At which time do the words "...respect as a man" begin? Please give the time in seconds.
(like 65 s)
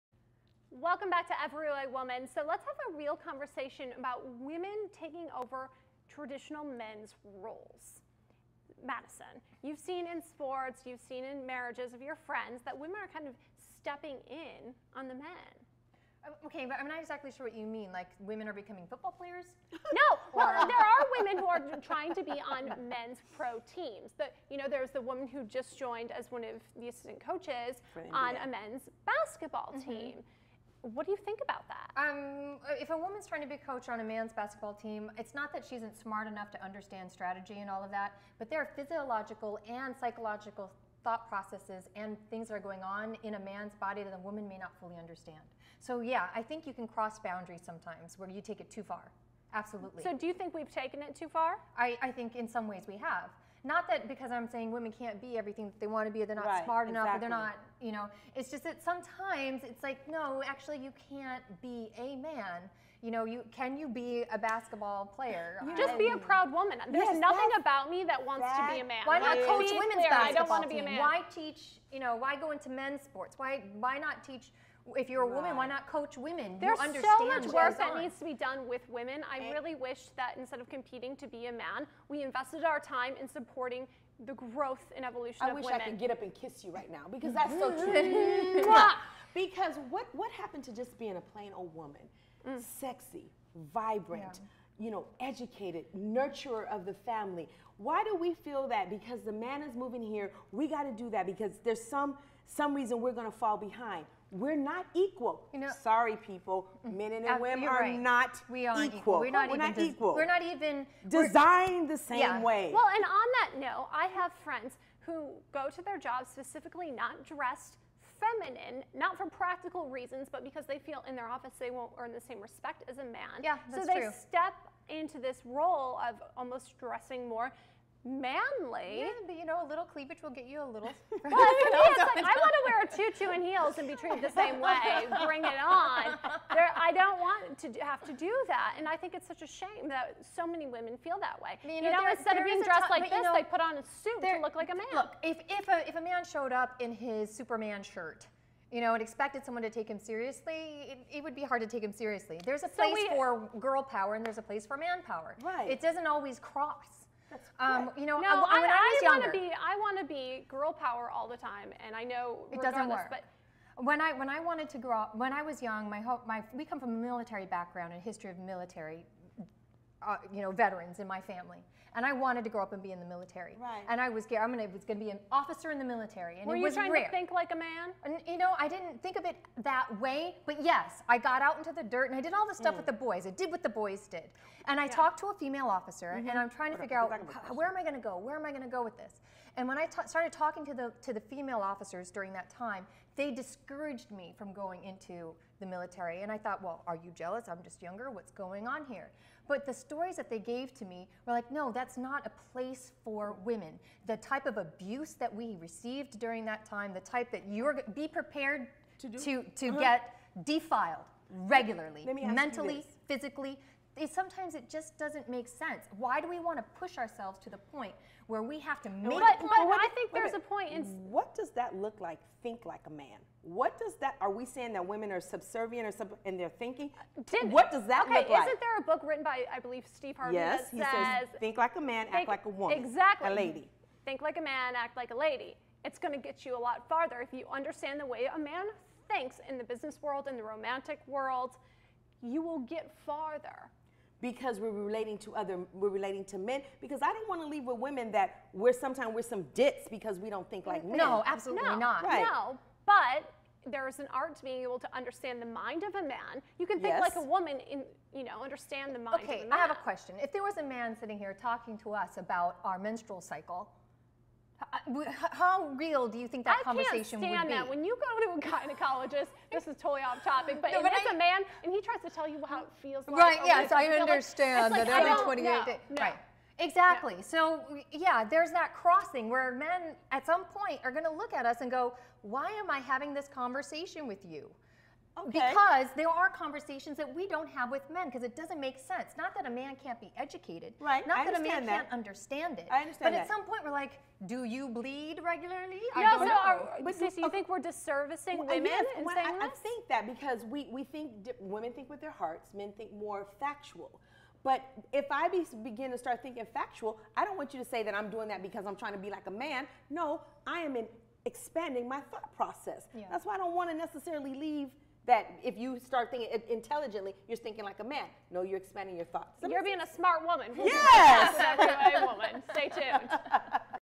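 122 s.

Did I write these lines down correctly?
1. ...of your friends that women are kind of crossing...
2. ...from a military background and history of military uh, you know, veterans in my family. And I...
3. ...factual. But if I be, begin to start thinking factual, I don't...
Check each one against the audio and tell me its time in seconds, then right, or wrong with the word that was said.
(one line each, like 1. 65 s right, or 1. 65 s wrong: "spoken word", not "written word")
1. 11 s wrong: "stepping", not "crossing"
2. 166 s right
3. 303 s right.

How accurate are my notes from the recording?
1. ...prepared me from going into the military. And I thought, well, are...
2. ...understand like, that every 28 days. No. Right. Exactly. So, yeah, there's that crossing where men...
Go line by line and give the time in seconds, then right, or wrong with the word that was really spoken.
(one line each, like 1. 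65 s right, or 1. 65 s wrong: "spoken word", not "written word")
1. 193 s wrong: "discouraged", not "prepared"
2. 273 s right.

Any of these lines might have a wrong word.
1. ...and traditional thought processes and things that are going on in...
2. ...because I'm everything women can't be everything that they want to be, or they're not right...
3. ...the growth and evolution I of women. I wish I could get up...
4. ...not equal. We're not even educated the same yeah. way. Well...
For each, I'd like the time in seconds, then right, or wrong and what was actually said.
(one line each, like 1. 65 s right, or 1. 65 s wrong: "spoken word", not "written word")
1. 39 s wrong: "psychological", not "traditional"
2. 54 s wrong: "saying", not "everything"
3. 84 s right
4. 109 s wrong: "designed", not "educated".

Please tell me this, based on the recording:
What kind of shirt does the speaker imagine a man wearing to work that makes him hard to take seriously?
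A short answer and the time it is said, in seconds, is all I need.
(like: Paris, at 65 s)
Superman shirt, at 147 s.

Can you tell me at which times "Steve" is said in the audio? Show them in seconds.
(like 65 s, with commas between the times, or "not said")
229 s.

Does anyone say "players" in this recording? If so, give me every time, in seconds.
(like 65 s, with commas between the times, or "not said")
19 s, 65 s.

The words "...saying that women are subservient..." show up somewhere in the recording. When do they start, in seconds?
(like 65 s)
224 s.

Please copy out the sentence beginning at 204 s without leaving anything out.
The type of abuse that we received during that time, the type that you're, be prepared to, do.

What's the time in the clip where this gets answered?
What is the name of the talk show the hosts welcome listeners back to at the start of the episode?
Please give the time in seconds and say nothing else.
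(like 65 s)
1 s.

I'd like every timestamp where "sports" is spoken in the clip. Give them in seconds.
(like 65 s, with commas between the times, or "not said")
10 s, 73 s.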